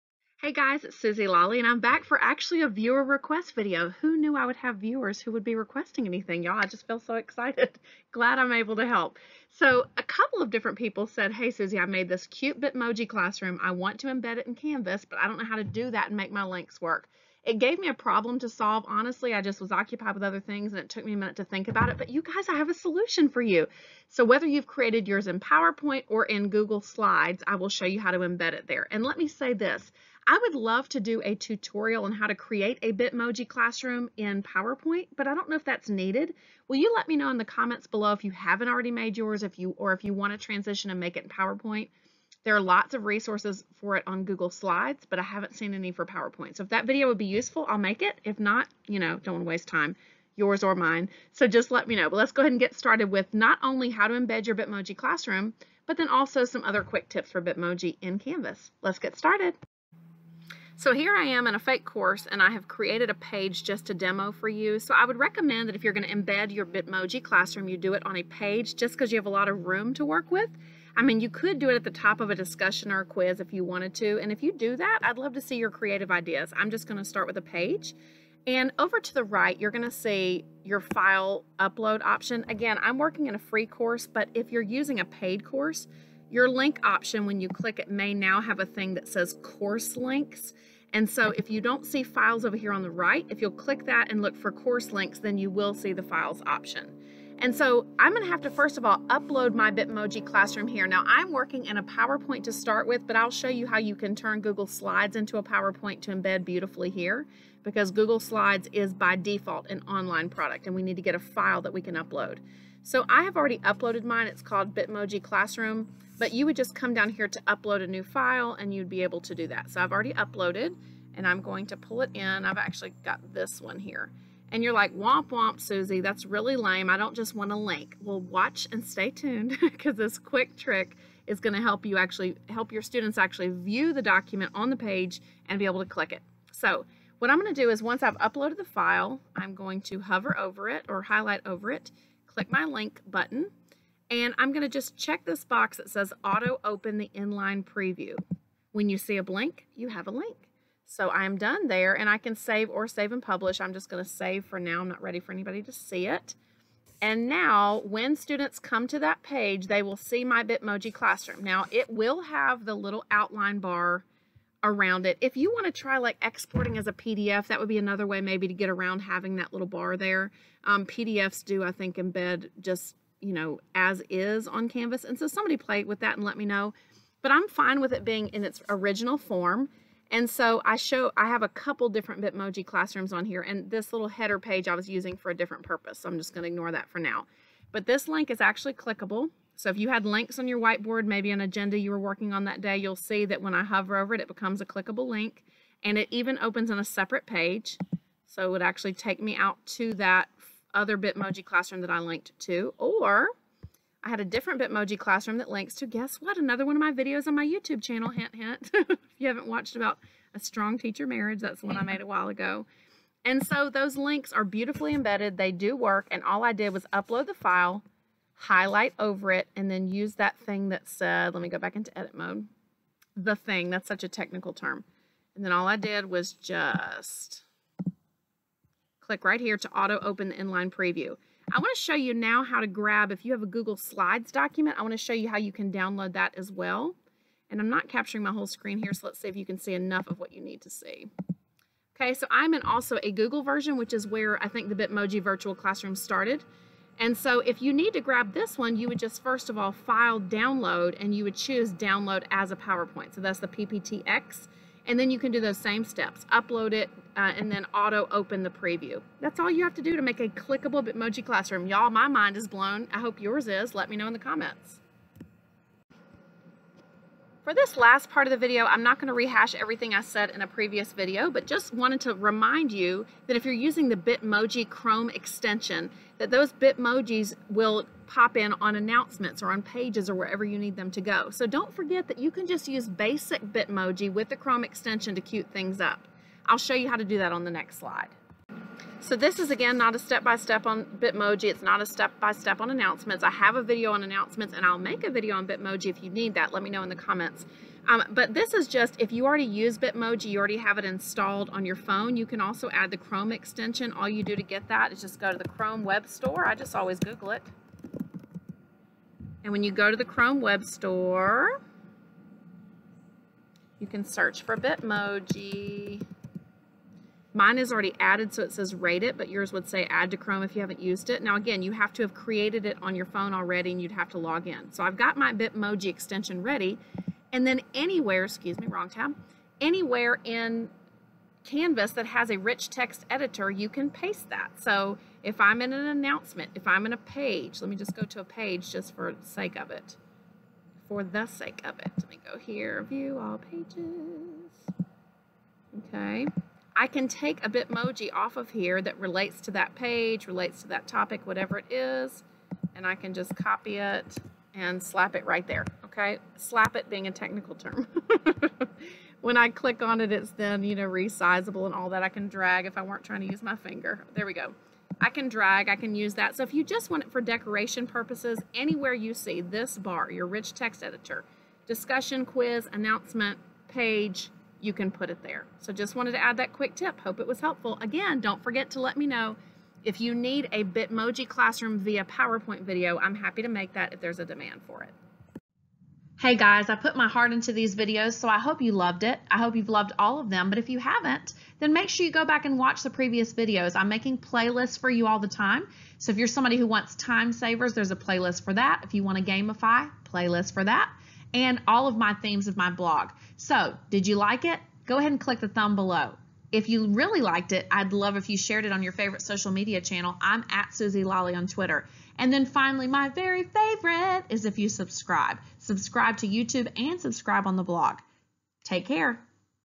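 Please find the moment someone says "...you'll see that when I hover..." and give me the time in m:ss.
3:12.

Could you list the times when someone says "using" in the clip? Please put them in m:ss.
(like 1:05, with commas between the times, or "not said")
1:24, 3:04, 4:33.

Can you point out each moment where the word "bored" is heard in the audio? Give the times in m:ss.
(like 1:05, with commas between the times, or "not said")
not said.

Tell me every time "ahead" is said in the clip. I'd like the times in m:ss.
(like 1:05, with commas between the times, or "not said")
0:52, 6:44.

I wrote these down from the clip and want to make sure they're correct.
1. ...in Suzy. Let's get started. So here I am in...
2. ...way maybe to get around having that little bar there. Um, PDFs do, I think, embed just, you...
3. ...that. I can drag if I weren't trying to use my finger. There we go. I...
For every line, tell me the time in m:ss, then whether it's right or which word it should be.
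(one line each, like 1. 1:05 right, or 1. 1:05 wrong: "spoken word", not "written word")
1. 0:58 wrong: "Canvas", not "Suzy"
2. 2:48 right
3. 6:01 right.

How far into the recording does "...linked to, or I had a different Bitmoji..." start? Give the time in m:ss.
3:21.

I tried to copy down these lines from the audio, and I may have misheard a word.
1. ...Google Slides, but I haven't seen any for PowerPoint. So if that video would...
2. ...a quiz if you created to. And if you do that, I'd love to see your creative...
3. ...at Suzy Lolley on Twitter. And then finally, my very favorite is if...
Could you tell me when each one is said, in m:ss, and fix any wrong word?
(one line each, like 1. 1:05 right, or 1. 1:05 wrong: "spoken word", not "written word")
1. 0:44 right
2. 1:13 wrong: "wanted", not "created"
3. 6:50 right.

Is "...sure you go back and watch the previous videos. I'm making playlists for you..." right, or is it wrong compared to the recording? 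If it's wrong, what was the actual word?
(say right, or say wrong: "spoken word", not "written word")
right.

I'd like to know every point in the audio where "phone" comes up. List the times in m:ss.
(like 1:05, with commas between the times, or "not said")
5:01, 5:23.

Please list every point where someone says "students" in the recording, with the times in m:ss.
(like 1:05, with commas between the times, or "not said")
2:12, 2:38.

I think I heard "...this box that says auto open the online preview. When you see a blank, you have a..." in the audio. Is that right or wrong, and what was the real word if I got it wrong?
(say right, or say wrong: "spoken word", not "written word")
wrong: "inline", not "online".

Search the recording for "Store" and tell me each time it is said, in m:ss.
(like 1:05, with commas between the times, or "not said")
5:06, 5:10.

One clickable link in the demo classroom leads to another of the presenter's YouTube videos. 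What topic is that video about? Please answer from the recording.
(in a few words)
A strong teacher marriage.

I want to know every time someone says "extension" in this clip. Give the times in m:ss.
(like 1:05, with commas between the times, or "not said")
4:35, 4:44, 5:03, 5:25.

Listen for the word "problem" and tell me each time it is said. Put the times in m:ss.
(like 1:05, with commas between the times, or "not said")
0:17.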